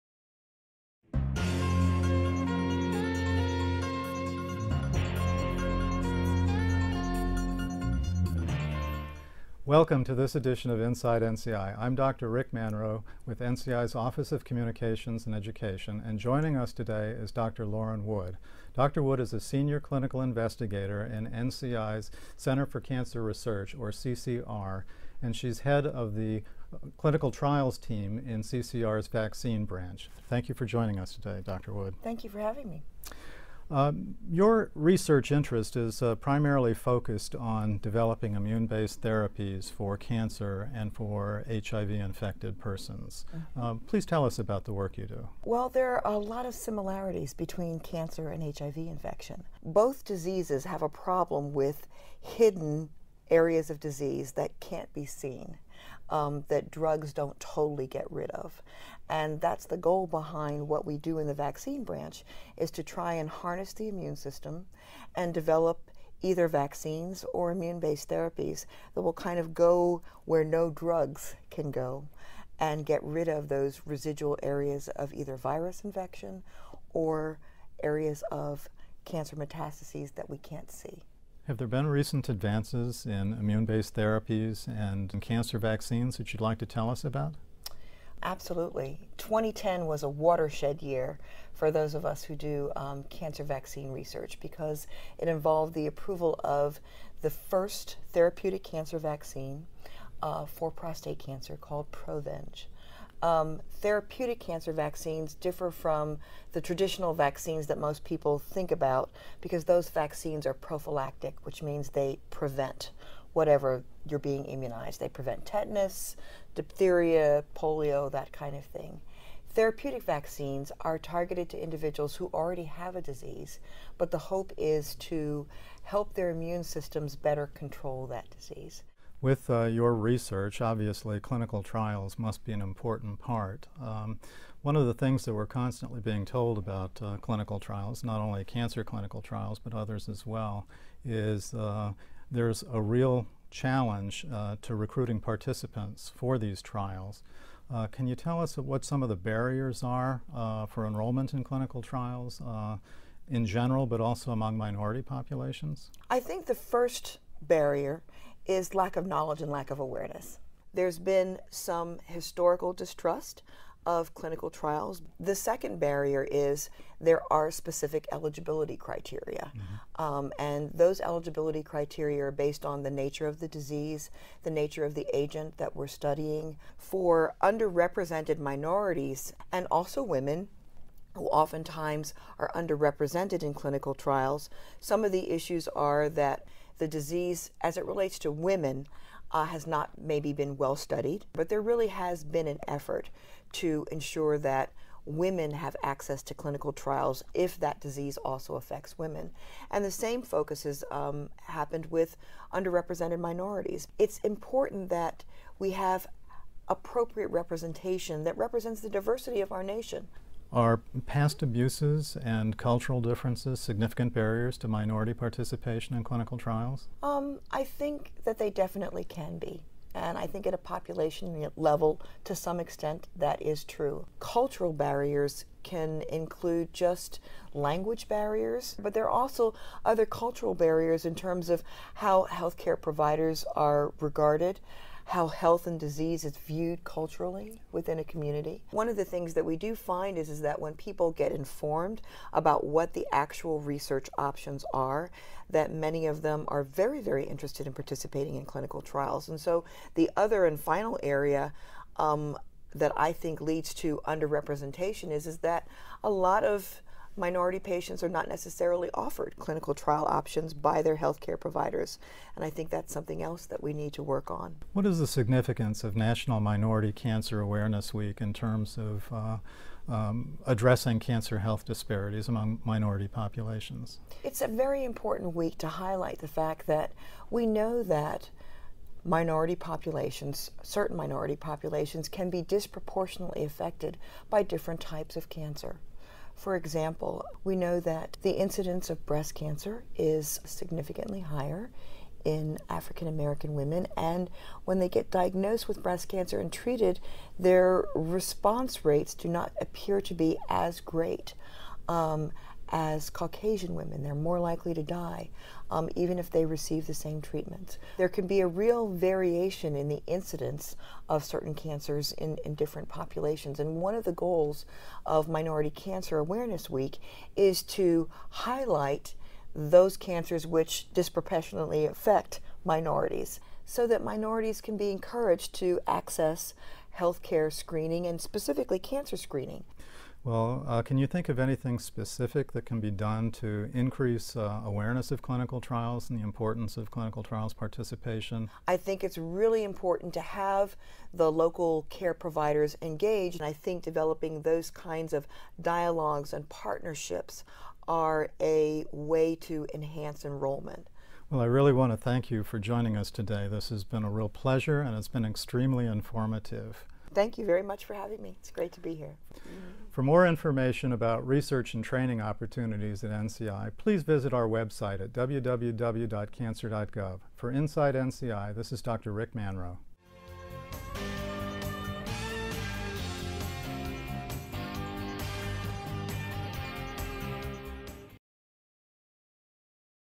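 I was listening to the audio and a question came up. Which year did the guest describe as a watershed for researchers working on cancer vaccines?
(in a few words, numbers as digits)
2010.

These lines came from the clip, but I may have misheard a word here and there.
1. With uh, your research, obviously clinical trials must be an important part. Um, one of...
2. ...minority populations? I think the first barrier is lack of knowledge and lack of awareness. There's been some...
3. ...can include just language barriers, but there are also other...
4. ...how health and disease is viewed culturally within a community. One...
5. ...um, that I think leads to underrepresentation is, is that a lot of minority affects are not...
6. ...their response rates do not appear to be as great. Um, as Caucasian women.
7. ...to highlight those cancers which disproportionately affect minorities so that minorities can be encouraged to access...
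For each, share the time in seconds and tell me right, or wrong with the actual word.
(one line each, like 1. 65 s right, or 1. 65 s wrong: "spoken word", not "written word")
1. 129 s right
2. 154 s right
3. 225 s right
4. 235 s right
5. 251 s wrong: "patients", not "affects"
6. 297 s right
7. 317 s right.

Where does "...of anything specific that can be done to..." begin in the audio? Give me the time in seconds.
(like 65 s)
331 s.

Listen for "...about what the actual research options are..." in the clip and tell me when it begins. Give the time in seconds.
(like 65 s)
242 s.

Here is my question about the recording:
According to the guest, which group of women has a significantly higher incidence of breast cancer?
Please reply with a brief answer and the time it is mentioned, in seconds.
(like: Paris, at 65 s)
African American women, at 292 s.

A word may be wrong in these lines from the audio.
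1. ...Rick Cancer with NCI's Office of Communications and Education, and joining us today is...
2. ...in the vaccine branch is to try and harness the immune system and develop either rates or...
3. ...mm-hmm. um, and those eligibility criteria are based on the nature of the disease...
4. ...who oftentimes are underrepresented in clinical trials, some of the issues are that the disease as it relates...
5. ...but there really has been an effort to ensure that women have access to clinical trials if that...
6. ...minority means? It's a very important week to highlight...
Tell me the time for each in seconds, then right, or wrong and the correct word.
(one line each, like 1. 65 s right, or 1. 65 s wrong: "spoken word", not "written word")
1. 12 s wrong: "Manrow", not "Cancer"
2. 61 s wrong: "vaccines", not "rates"
3. 169 s right
4. 181 s right
5. 191 s right
6. 272 s wrong: "populations", not "means".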